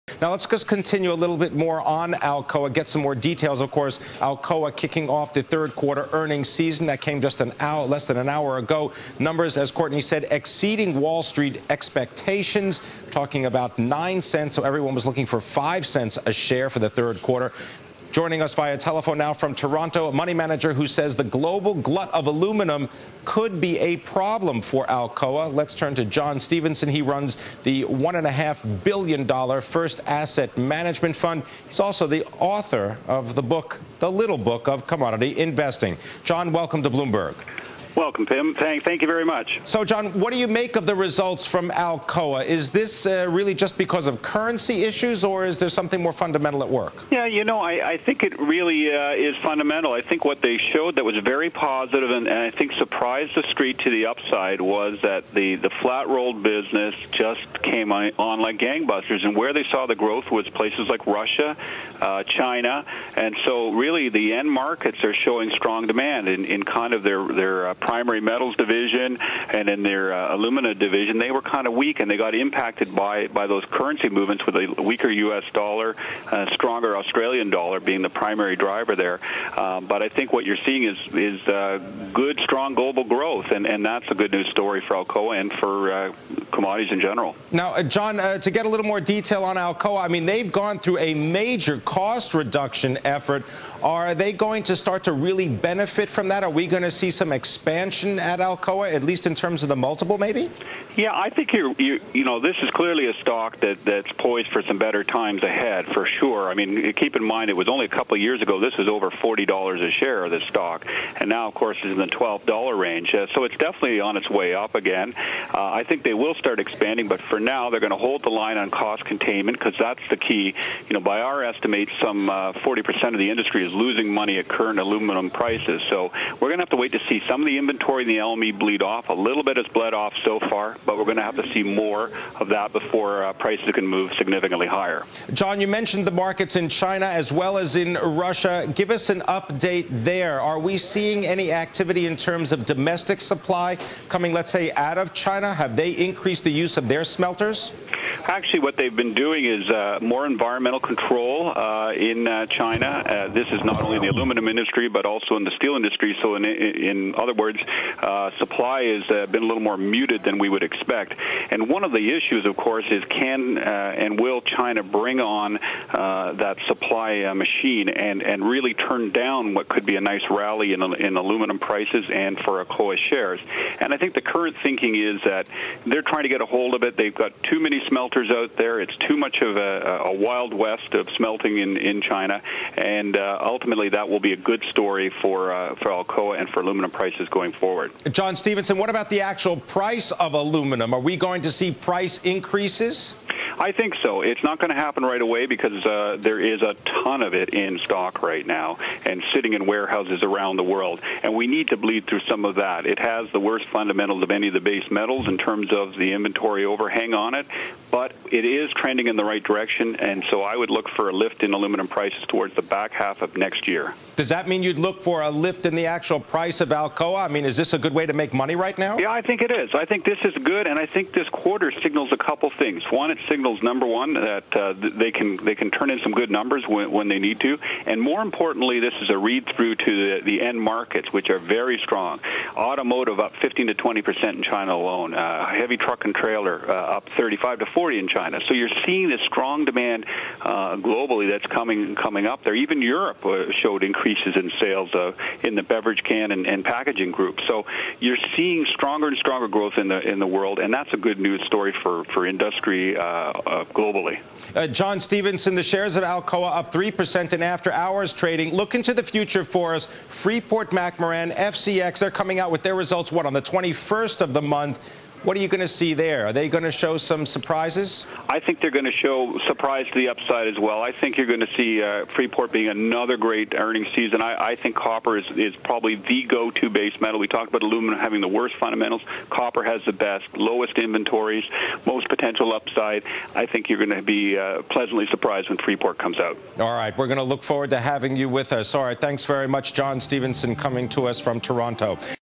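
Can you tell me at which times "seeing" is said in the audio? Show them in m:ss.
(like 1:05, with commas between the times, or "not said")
1:20, 2:20, 3:58, 4:08.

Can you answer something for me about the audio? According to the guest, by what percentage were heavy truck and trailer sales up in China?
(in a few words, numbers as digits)
35 to 40.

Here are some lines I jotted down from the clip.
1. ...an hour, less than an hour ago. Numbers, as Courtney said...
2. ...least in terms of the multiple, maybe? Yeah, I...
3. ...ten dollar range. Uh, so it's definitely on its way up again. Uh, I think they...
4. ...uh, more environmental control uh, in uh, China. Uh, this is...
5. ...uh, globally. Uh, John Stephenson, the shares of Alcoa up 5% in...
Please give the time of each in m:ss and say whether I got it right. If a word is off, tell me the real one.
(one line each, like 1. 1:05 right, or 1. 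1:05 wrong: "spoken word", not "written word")
1. 0:07 right
2. 1:39 right
3. 1:52 wrong: "twelve", not "ten"
4. 2:29 right
5. 4:13 wrong: "3", not "5".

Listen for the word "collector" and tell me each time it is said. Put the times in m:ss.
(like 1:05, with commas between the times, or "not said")
not said.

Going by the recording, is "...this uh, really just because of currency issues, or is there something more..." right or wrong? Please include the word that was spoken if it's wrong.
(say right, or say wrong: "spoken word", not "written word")
right.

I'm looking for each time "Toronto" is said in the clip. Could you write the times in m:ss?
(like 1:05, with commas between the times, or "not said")
0:19, 4:51.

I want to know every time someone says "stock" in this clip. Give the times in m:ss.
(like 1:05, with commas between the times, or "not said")
1:43, 1:50, 3:17.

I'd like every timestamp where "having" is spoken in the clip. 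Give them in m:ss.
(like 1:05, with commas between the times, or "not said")
4:37, 4:47.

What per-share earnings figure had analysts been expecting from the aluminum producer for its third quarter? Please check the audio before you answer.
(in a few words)
5 cents.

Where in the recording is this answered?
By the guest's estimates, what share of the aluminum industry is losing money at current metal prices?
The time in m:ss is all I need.
2:02.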